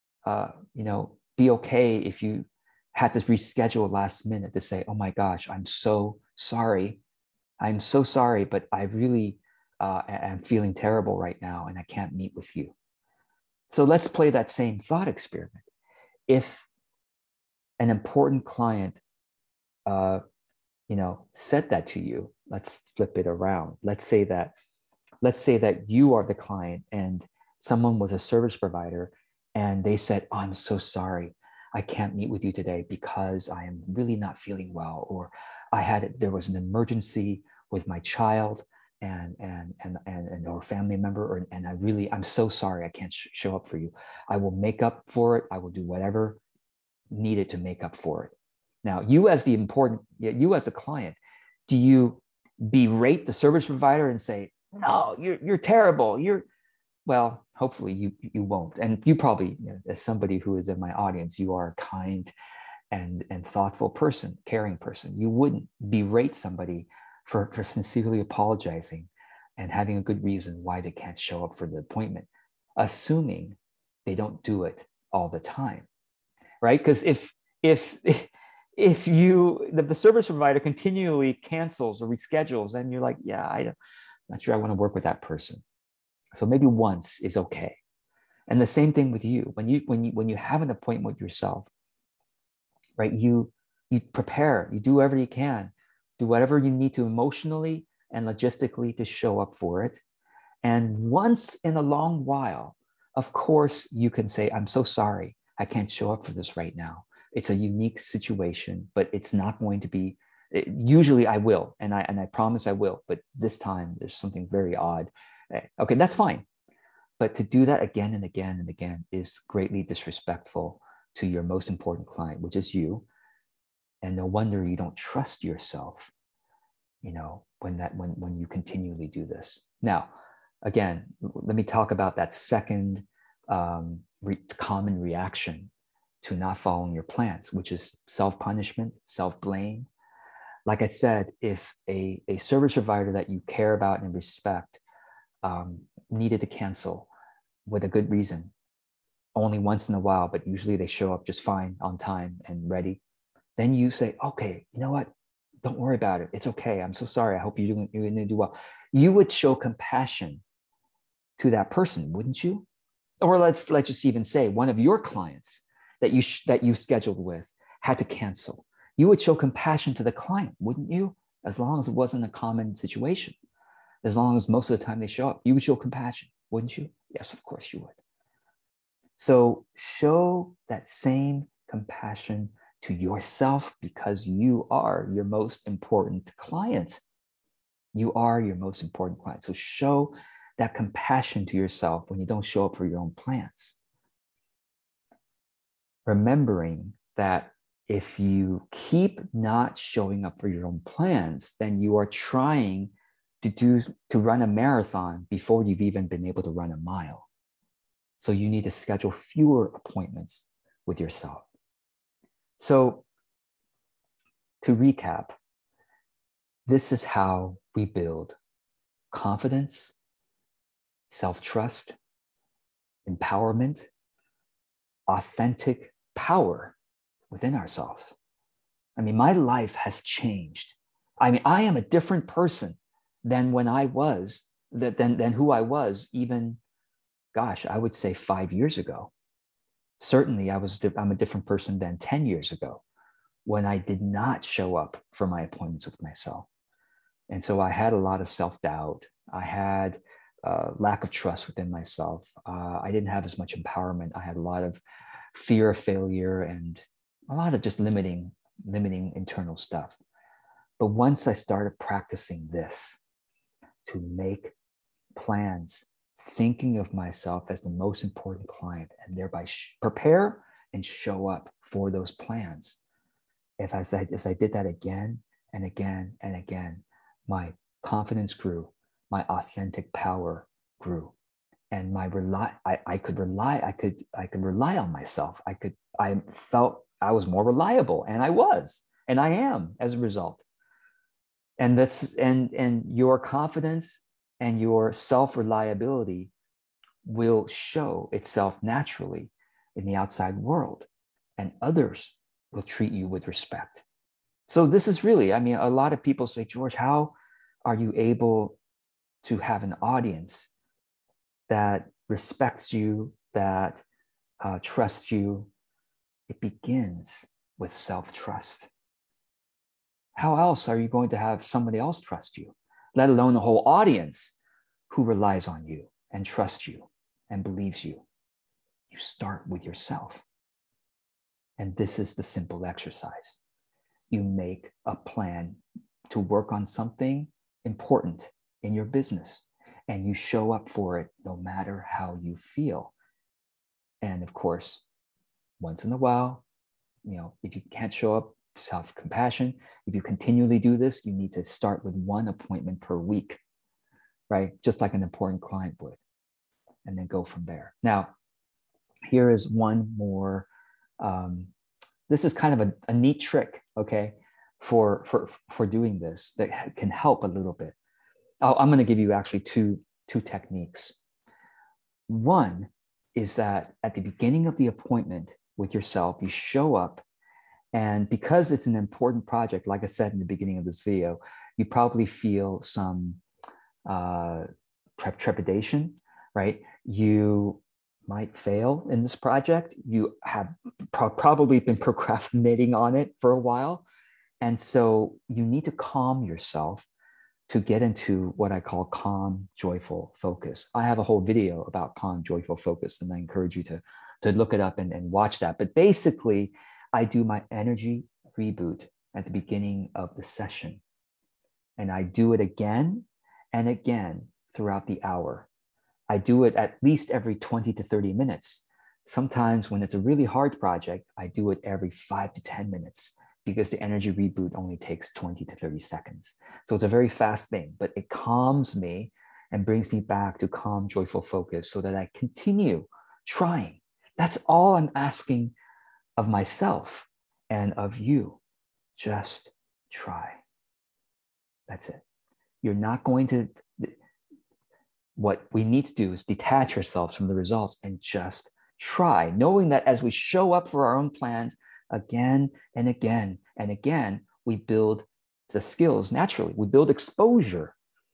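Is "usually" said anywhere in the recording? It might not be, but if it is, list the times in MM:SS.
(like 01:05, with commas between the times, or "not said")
01:50, 02:30.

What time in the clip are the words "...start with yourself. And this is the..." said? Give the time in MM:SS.
05:28.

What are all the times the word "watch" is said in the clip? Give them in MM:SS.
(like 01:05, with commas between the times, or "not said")
06:45.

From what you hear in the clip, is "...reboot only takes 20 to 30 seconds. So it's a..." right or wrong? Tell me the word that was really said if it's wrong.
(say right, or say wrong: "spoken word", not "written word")
right.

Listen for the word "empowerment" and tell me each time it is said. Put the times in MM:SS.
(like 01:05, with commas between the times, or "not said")
03:43, 04:13.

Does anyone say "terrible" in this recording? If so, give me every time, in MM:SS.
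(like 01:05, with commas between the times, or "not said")
00:10, 00:55.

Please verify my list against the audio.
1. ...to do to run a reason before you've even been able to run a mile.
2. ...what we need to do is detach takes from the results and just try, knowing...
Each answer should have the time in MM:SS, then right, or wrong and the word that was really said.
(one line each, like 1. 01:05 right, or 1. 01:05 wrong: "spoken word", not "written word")
1. 03:23 wrong: "marathon", not "reason"
2. 07:25 wrong: "ourselves", not "takes".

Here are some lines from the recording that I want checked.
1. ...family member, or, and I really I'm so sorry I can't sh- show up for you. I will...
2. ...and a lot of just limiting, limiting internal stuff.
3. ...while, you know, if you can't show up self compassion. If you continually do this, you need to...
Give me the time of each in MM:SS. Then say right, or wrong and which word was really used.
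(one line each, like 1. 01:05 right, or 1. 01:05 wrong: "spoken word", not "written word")
1. 00:40 right
2. 04:16 right
3. 05:45 right.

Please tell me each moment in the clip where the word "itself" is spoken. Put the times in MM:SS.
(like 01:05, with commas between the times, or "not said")
04:58.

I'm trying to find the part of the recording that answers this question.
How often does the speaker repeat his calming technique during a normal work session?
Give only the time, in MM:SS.
06:57.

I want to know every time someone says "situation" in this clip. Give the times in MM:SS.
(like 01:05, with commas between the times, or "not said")
01:47, 02:52.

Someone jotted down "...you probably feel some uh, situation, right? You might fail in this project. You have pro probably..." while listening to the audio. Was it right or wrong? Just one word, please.
wrong.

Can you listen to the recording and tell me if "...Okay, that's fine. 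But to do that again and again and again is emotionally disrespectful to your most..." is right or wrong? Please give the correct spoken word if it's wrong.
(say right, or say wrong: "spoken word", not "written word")
wrong: "greatly", not "emotionally".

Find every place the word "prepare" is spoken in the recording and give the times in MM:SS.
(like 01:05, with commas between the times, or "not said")
01:33, 04:29.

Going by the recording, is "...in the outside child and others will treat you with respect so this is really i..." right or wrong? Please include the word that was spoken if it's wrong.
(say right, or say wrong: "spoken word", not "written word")
wrong: "world", not "child".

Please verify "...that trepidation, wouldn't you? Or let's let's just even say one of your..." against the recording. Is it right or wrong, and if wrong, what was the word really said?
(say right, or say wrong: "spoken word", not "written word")
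wrong: "person", not "trepidation".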